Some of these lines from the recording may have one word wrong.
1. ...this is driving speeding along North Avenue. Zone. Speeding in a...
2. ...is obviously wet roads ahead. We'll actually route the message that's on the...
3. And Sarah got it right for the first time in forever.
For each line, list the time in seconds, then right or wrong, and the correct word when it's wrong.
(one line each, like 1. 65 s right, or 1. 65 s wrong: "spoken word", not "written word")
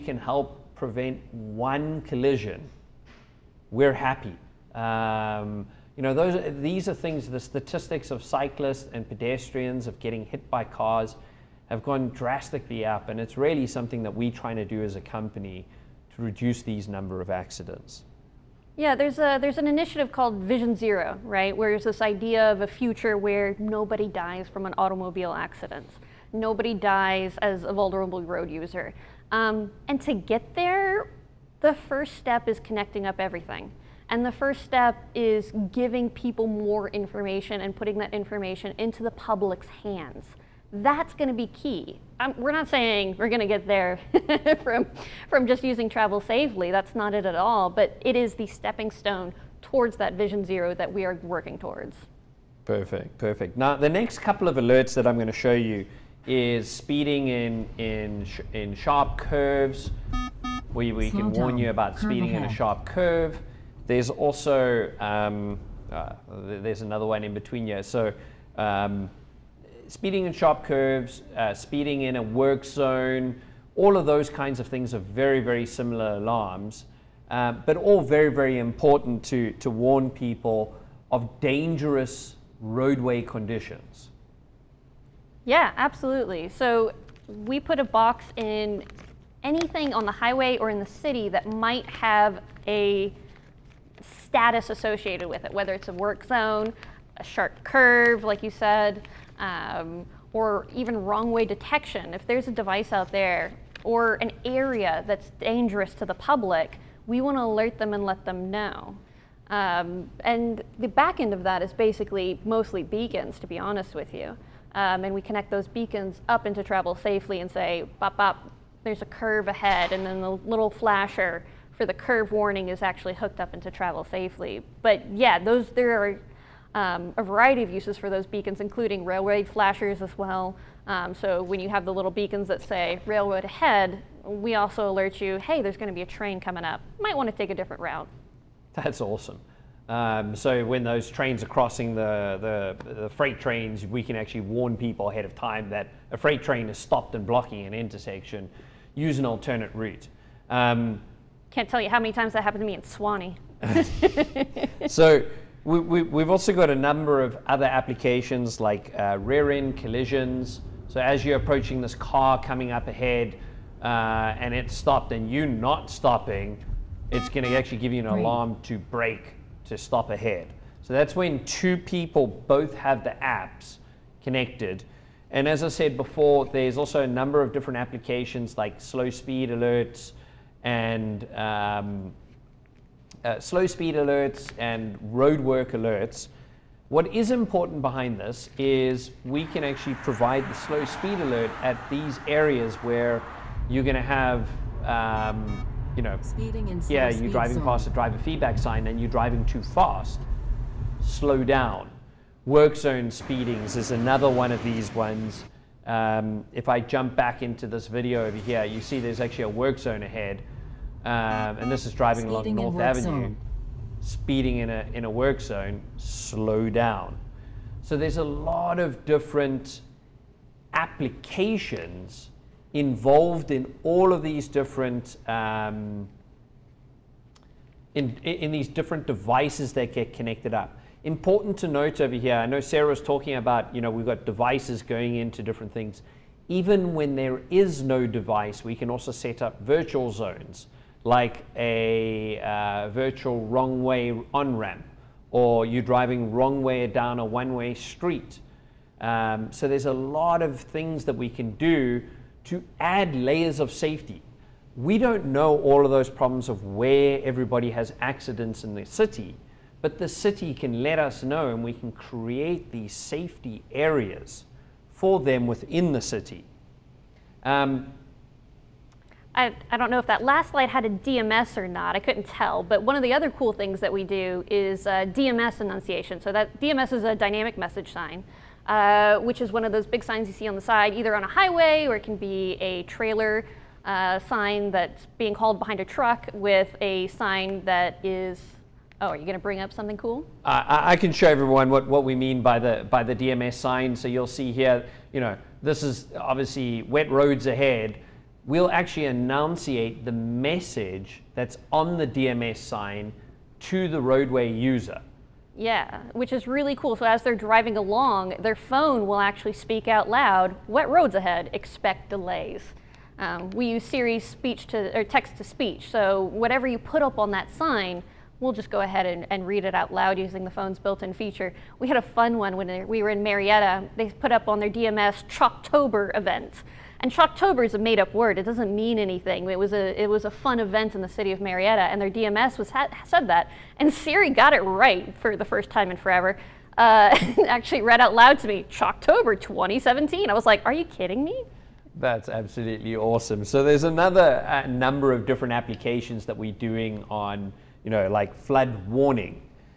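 1. 211 s right
2. 295 s wrong: "enunciate", not "route"
3. 333 s wrong: "Siri", not "Sarah".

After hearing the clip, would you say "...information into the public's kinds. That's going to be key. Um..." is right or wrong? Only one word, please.
wrong.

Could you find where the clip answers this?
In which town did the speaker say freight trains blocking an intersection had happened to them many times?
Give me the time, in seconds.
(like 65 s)
152 s.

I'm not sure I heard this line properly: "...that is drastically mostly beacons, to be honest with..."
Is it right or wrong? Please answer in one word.
wrong.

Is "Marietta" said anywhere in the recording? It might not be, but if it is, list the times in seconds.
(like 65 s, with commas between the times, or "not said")
323 s, 331 s.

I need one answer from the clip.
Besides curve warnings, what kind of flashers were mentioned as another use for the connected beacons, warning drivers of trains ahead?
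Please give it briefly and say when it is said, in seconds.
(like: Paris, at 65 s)
railway flashers, at 129 s.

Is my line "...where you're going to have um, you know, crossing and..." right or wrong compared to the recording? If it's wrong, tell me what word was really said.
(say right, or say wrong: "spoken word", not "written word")
wrong: "speeding", not "crossing".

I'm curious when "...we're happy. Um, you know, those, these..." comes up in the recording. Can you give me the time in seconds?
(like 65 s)
3 s.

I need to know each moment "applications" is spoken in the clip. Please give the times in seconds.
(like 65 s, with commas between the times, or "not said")
157 s, 177 s, 220 s, 345 s.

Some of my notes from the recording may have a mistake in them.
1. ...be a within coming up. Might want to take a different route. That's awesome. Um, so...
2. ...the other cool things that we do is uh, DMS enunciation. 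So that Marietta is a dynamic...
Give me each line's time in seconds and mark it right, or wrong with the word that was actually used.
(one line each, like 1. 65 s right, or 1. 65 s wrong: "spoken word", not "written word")
1. 135 s wrong: "train", not "within"
2. 273 s wrong: "DMS", not "Marietta".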